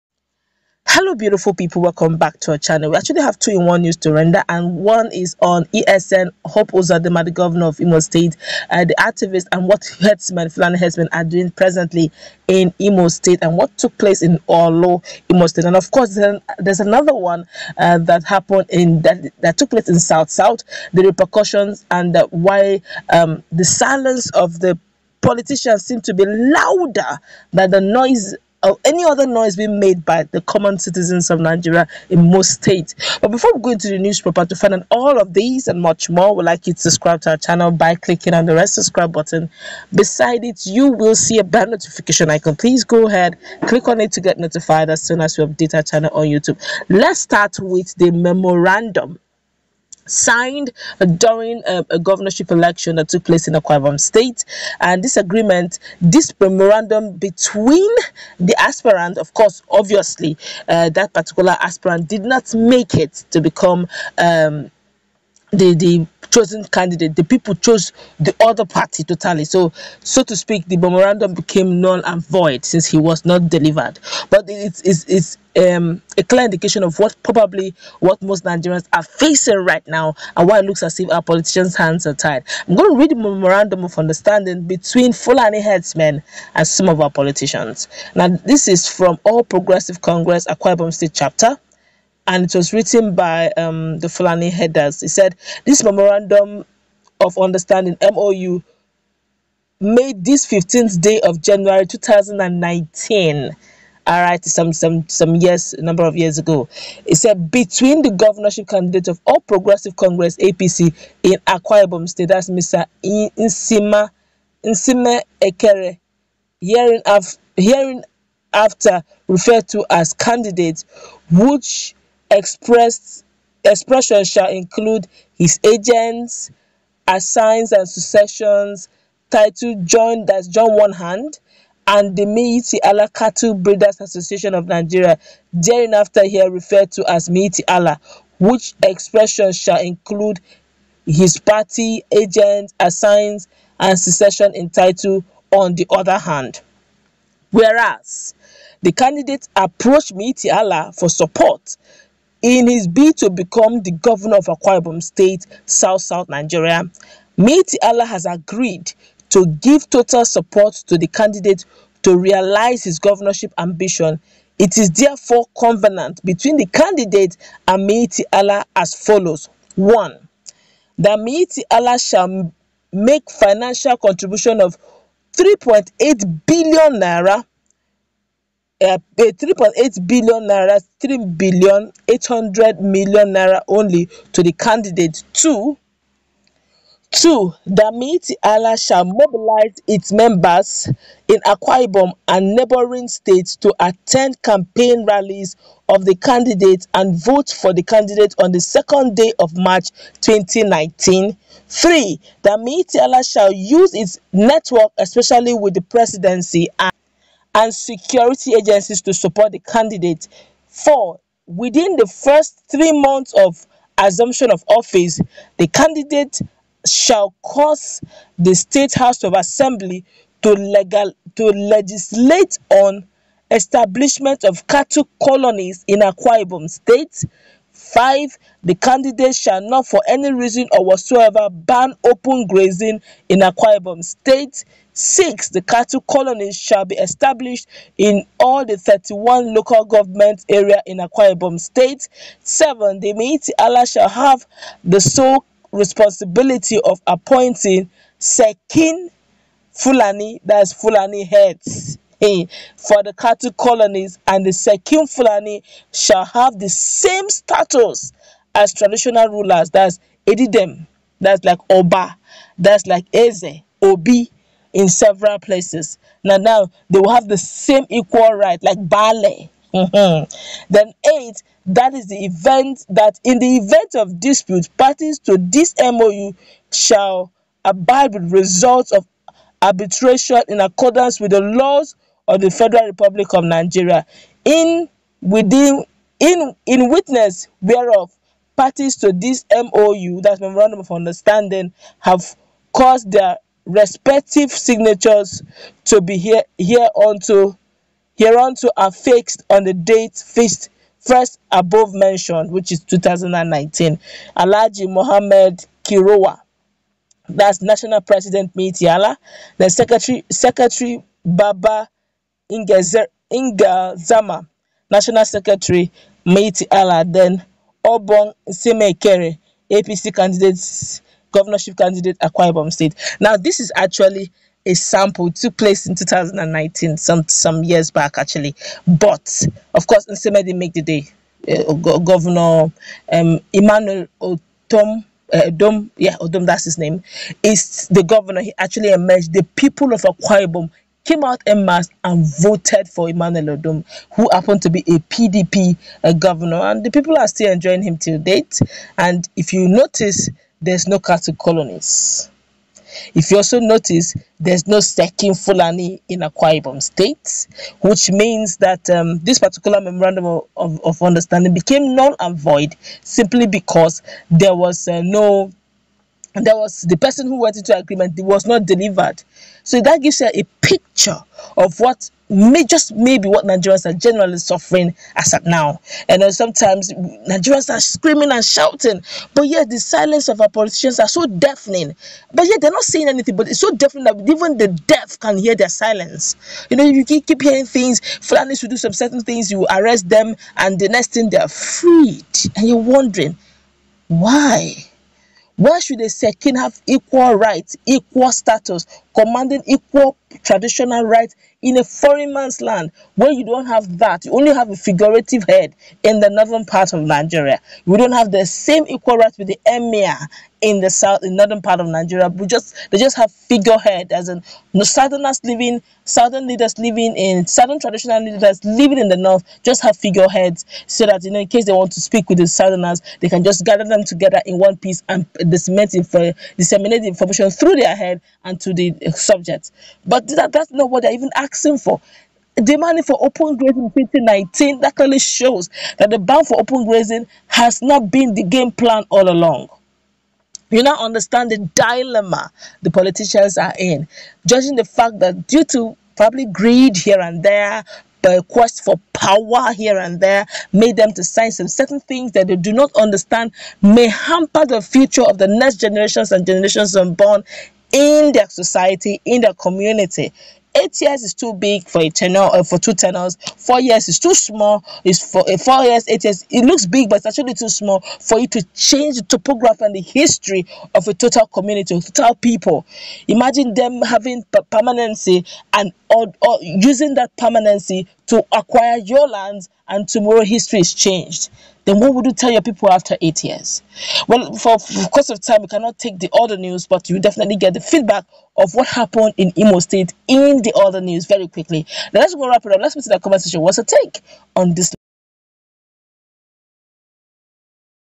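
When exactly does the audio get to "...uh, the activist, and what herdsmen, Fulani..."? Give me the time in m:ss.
0:08.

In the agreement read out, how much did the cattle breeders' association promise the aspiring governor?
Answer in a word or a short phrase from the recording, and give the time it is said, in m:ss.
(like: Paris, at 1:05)
3.8 billion naira, at 3:00.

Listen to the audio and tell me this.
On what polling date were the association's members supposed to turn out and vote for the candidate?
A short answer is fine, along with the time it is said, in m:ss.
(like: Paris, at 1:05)
2 March 2019, at 3:18.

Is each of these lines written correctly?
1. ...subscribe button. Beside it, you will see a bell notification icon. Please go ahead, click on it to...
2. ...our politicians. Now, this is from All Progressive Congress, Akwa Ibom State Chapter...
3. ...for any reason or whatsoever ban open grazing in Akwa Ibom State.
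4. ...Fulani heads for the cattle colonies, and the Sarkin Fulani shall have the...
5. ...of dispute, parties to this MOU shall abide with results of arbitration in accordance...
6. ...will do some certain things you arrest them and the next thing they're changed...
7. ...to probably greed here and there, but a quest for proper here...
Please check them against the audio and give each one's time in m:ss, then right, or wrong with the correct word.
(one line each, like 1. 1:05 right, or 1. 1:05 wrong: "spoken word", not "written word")
1. 0:38 right
2. 1:27 right
3. 3:49 right
4. 4:10 right
5. 4:33 right
6. 6:28 wrong: "freed", not "changed"
7. 7:25 wrong: "power", not "proper".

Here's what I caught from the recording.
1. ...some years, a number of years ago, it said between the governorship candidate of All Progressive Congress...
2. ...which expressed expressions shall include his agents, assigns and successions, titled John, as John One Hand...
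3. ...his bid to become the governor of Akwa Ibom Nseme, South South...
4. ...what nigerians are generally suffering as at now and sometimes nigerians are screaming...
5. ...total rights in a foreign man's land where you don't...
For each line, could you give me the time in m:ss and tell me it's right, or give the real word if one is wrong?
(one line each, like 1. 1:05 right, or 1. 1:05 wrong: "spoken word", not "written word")
1. 1:45 right
2. 2:01 right
3. 2:32 wrong: "State", not "Nseme"
4. 6:13 right
5. 6:40 wrong: "traditional", not "total".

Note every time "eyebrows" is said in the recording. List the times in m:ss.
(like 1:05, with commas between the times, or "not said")
not said.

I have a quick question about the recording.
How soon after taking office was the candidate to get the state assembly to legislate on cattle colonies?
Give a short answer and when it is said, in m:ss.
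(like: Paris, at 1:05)
first three months, at 3:32.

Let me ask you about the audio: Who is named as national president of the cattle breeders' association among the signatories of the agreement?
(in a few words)
Alhaji Mohammed Kirowa.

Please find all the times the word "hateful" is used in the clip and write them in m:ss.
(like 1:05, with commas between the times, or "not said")
not said.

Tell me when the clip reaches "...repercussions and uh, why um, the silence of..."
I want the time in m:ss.
0:21.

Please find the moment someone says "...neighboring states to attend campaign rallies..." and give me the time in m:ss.
3:12.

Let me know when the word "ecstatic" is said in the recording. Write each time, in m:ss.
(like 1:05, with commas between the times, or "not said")
not said.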